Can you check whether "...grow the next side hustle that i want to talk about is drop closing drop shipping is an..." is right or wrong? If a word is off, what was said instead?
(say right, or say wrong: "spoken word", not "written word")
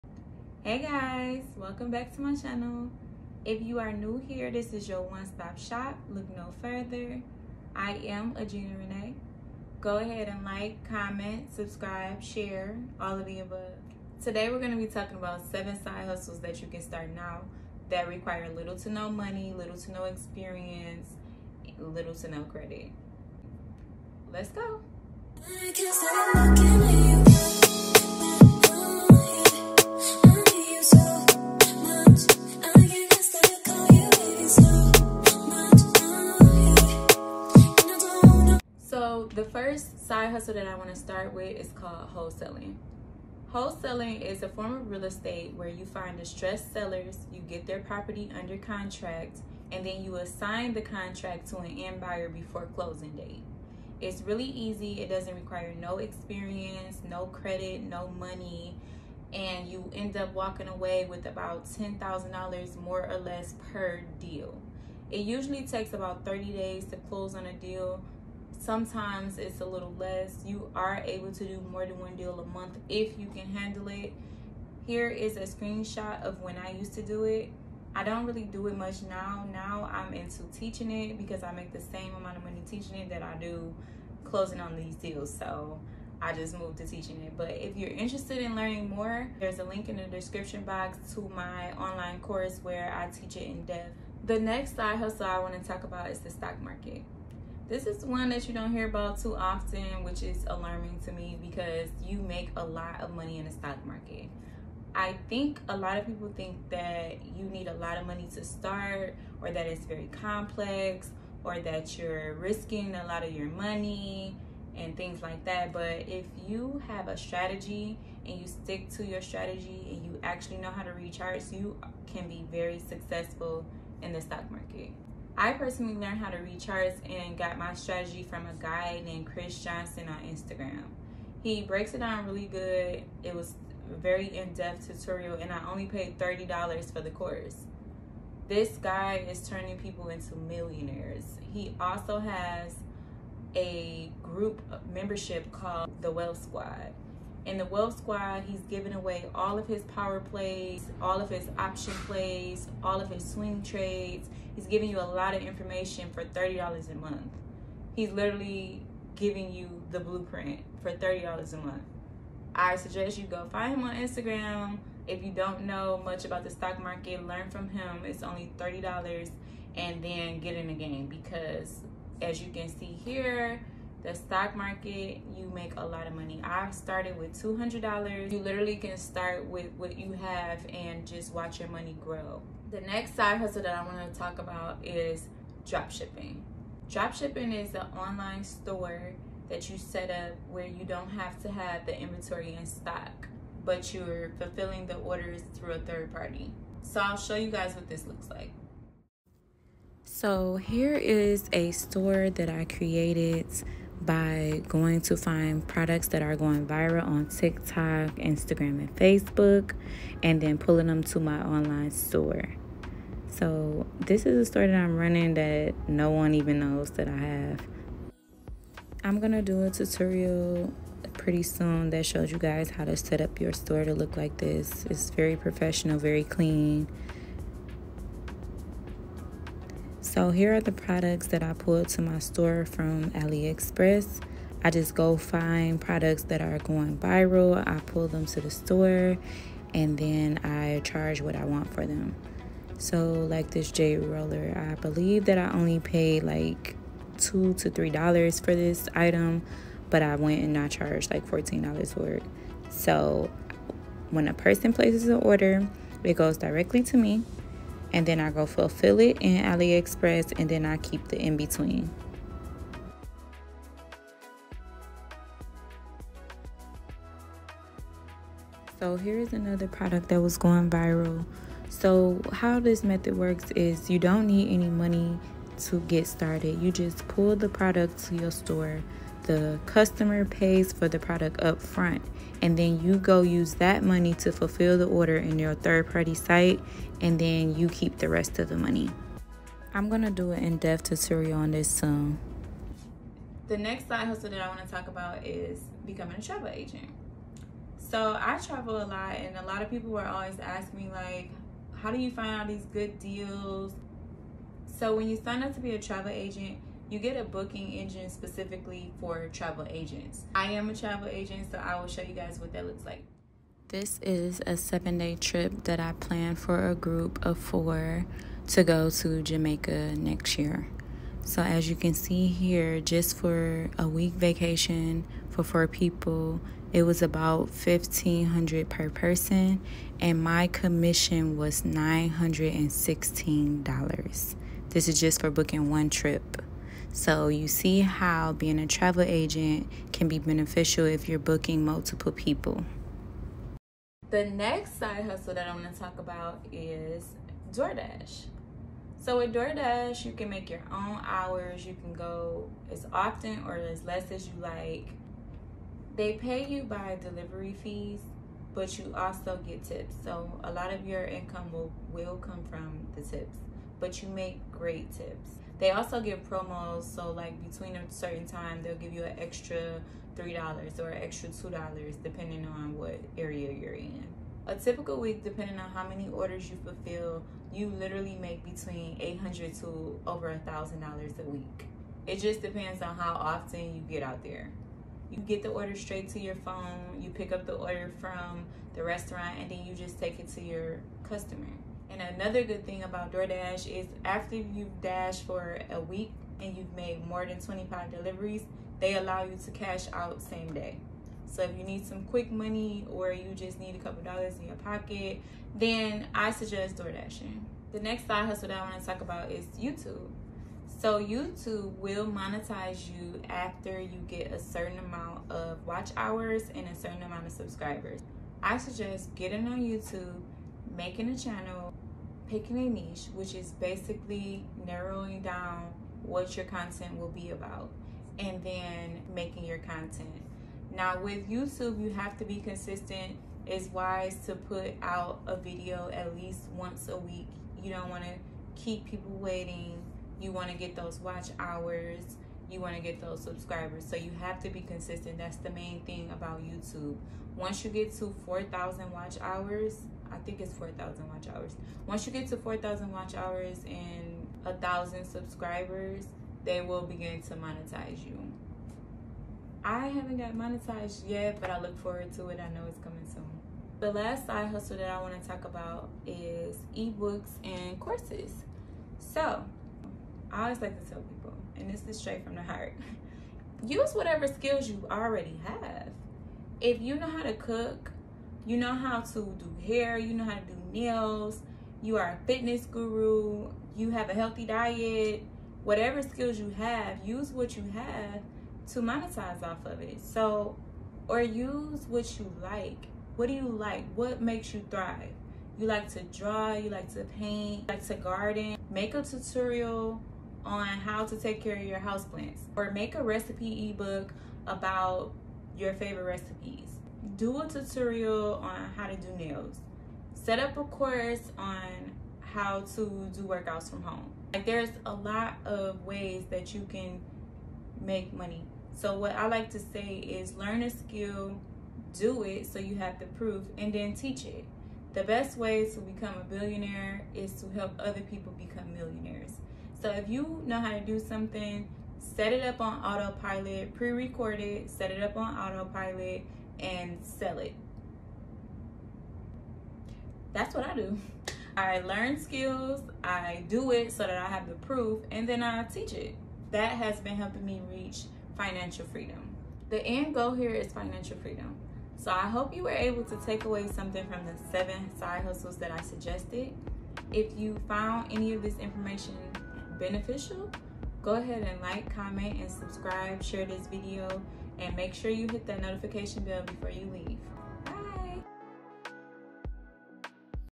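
wrong: "shipping", not "closing".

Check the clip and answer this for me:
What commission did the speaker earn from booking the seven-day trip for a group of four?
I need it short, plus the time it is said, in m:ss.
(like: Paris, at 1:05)
$916, at 5:31.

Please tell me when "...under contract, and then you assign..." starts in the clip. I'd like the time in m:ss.
0:48.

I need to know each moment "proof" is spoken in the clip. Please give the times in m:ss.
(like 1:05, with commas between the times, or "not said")
8:43, 9:04.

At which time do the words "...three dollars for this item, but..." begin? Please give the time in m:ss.
4:07.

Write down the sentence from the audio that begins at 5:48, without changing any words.
So with DoorDash, you can make your own hours.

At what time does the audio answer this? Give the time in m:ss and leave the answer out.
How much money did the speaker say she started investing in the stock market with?
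2:57.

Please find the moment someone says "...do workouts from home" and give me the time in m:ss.
8:33.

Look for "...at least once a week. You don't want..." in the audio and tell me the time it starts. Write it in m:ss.
7:15.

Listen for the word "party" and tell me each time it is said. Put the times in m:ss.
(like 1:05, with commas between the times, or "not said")
3:16, 4:45.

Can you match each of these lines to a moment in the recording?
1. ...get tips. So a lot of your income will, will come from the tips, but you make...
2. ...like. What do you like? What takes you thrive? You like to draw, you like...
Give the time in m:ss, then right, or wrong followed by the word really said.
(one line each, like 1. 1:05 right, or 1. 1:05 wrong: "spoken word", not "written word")
1. 5:59 right
2. 8:12 wrong: "makes", not "takes".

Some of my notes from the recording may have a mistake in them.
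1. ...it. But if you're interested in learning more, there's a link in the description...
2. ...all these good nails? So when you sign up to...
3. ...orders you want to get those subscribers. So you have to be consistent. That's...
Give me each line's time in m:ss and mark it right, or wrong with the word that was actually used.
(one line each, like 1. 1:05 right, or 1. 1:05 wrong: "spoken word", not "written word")
1. 1:27 right
2. 5:02 wrong: "deals", not "nails"
3. 7:21 wrong: "hours", not "orders".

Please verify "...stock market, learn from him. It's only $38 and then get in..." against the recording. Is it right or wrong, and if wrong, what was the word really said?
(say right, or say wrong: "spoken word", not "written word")
wrong: "30", not "38".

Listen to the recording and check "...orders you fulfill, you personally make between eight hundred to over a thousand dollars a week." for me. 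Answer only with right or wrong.
wrong.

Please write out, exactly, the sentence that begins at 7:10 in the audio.
Now, with YouTube, you have to be consistent.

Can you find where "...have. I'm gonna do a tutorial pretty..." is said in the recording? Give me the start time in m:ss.
3:37.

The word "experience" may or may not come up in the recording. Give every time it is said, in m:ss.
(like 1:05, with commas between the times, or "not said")
0:20, 0:55.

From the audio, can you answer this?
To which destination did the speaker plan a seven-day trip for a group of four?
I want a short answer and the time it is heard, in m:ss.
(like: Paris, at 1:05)
Jamaica, at 5:19.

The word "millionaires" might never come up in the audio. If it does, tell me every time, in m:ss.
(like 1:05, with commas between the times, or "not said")
2:20, 8:48.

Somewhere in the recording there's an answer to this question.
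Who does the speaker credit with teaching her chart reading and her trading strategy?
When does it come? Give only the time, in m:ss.
2:09.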